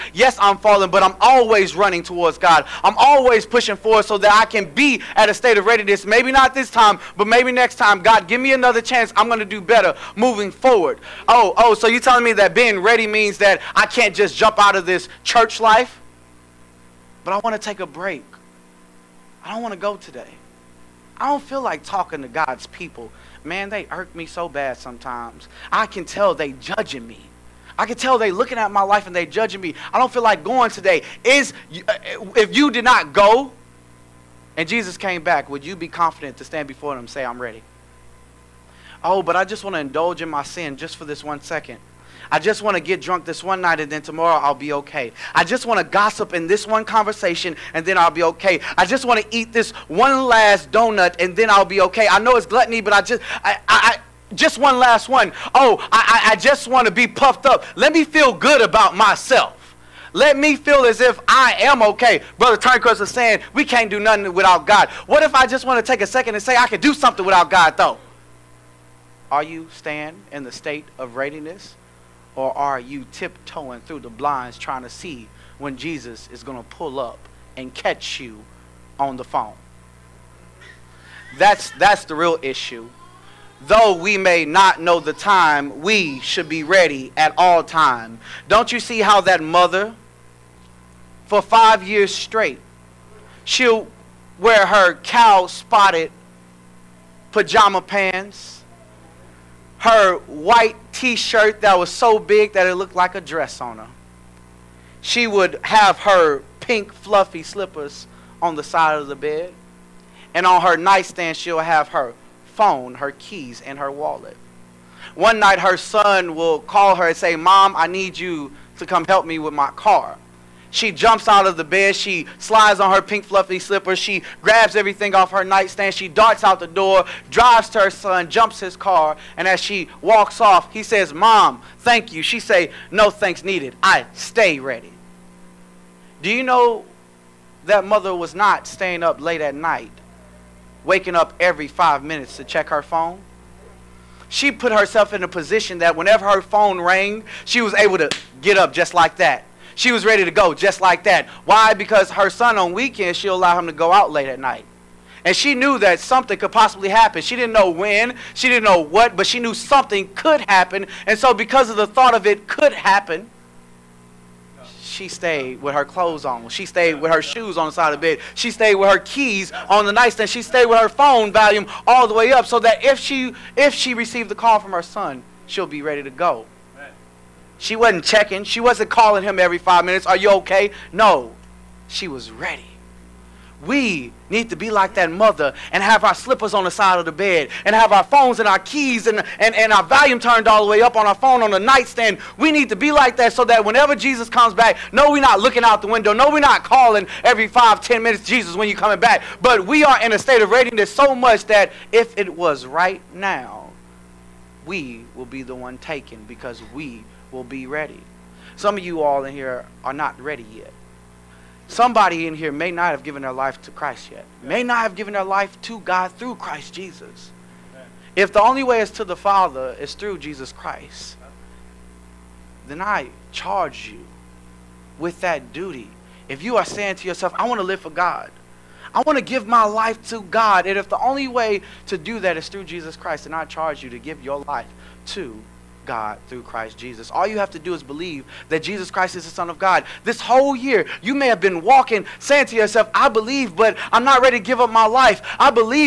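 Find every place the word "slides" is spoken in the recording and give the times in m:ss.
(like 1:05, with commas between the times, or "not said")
2:02.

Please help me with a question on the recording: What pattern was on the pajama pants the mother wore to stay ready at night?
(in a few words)
Cow-spotted.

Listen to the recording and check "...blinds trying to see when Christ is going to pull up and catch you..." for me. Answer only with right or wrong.
wrong.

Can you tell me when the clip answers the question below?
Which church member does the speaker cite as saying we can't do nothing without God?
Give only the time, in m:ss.
1:02.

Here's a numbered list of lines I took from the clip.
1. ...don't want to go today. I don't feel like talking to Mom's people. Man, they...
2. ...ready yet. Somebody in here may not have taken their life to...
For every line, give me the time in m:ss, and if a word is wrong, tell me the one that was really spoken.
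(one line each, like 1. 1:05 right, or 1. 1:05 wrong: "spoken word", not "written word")
1. 0:19 wrong: "God", not "Mom"
2. 3:30 wrong: "given", not "taken".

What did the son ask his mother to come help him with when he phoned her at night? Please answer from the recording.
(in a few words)
His car.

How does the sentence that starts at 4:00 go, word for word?
This whole year, you may have been walking, saying to yourself, I believe, but I'm not ready to give up my life.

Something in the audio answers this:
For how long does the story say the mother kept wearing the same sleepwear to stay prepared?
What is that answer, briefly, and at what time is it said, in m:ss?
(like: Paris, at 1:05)
5 years, at 1:31.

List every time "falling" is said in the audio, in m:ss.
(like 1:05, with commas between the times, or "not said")
0:00.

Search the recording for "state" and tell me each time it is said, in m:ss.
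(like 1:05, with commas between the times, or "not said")
0:05, 1:10, 3:20.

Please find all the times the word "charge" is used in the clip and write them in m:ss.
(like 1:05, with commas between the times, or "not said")
3:43, 3:53.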